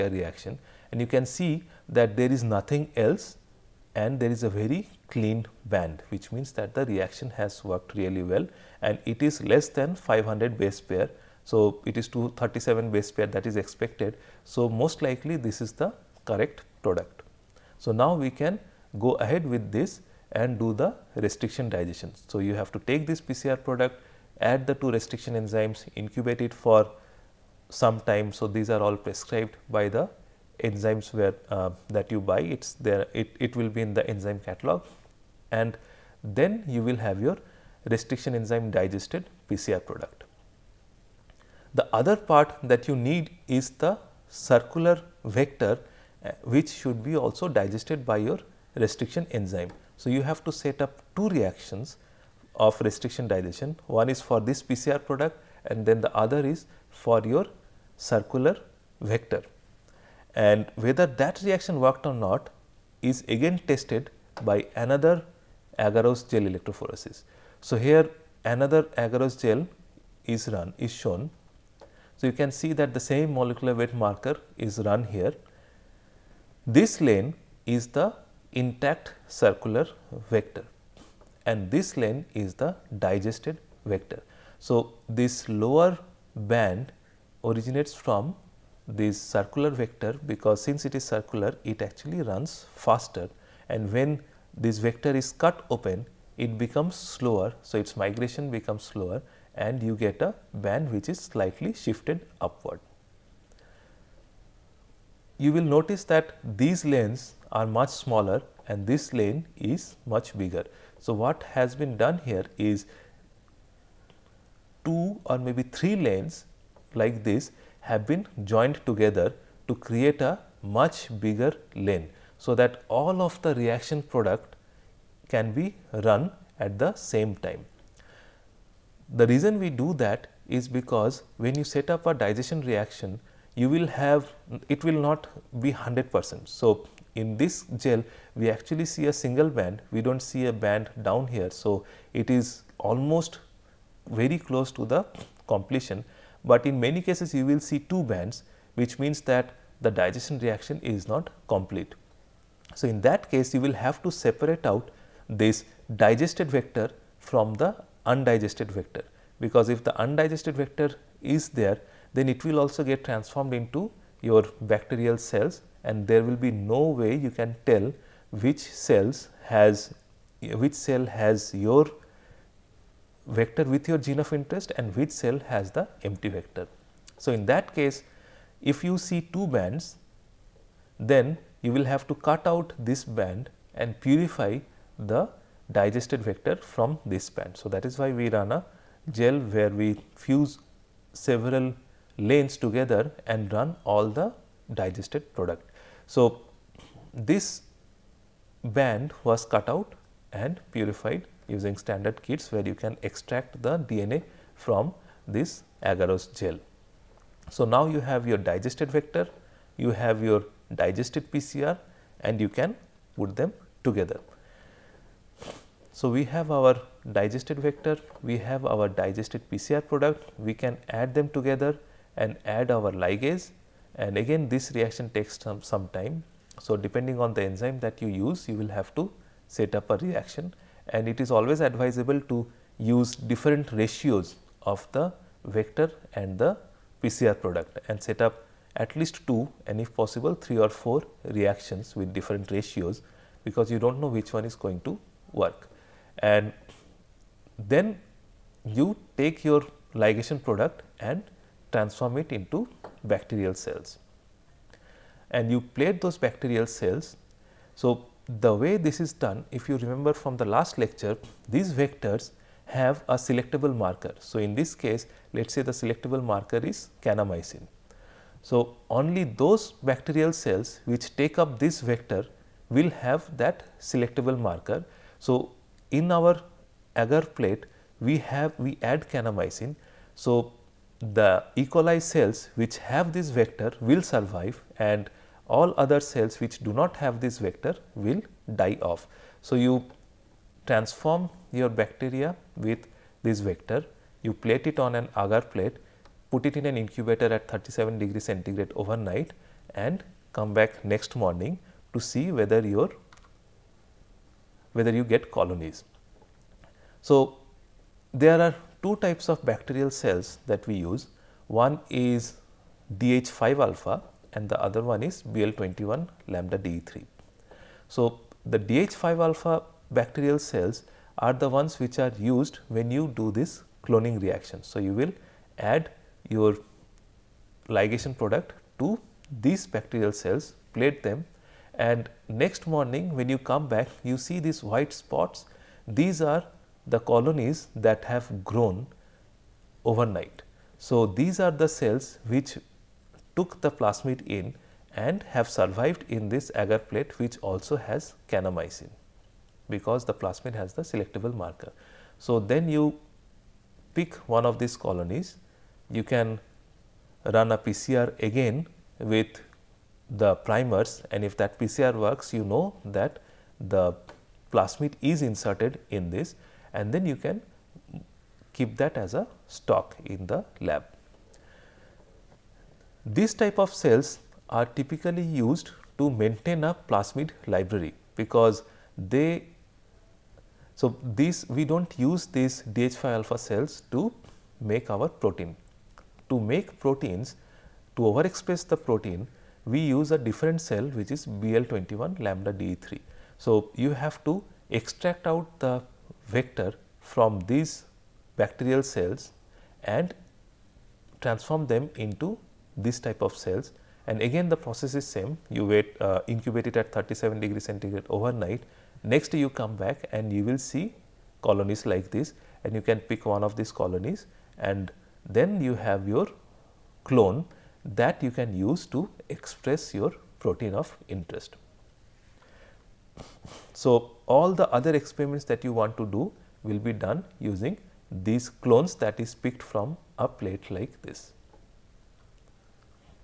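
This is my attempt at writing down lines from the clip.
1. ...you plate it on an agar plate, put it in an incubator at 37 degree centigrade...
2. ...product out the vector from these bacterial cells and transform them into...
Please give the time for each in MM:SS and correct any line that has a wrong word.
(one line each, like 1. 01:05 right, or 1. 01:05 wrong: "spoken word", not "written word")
1. 04:54 right
2. 06:34 wrong: "extract", not "product".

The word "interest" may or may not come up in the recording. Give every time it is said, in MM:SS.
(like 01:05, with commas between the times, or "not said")
02:54, 07:01.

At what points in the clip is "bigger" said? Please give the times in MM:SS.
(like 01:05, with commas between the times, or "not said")
01:50, 02:01.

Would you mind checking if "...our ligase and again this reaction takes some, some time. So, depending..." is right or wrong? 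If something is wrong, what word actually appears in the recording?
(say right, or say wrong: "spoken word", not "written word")
right.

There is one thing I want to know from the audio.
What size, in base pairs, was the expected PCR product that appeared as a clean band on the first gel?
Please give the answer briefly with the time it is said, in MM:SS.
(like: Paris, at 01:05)
237, at 00:12.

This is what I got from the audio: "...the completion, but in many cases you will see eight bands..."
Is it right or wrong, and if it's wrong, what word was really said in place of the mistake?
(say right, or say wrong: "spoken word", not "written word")
wrong: "two", not "eight".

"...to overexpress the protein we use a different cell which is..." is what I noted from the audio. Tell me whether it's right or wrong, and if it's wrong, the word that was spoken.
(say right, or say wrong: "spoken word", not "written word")
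right.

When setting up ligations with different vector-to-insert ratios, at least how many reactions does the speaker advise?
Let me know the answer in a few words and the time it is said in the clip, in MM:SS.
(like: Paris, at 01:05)
2, at 03:59.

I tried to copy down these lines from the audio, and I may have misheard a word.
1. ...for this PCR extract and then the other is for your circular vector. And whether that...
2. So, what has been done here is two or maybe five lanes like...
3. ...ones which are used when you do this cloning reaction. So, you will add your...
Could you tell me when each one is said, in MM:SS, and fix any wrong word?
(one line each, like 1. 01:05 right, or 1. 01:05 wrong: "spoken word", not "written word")
1. 00:54 wrong: "product", not "extract"
2. 01:50 wrong: "three", not "five"
3. 05:21 right.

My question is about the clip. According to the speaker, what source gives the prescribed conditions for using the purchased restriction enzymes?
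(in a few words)
Enzyme catalog.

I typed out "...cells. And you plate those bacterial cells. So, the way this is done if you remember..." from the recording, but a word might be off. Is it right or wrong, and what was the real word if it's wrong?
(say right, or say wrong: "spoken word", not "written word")
right.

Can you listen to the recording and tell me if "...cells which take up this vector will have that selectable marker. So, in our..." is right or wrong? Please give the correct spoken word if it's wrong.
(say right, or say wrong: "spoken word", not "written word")
right.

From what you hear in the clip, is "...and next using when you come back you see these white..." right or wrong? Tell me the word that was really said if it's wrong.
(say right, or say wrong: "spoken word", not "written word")
wrong: "morning", not "using".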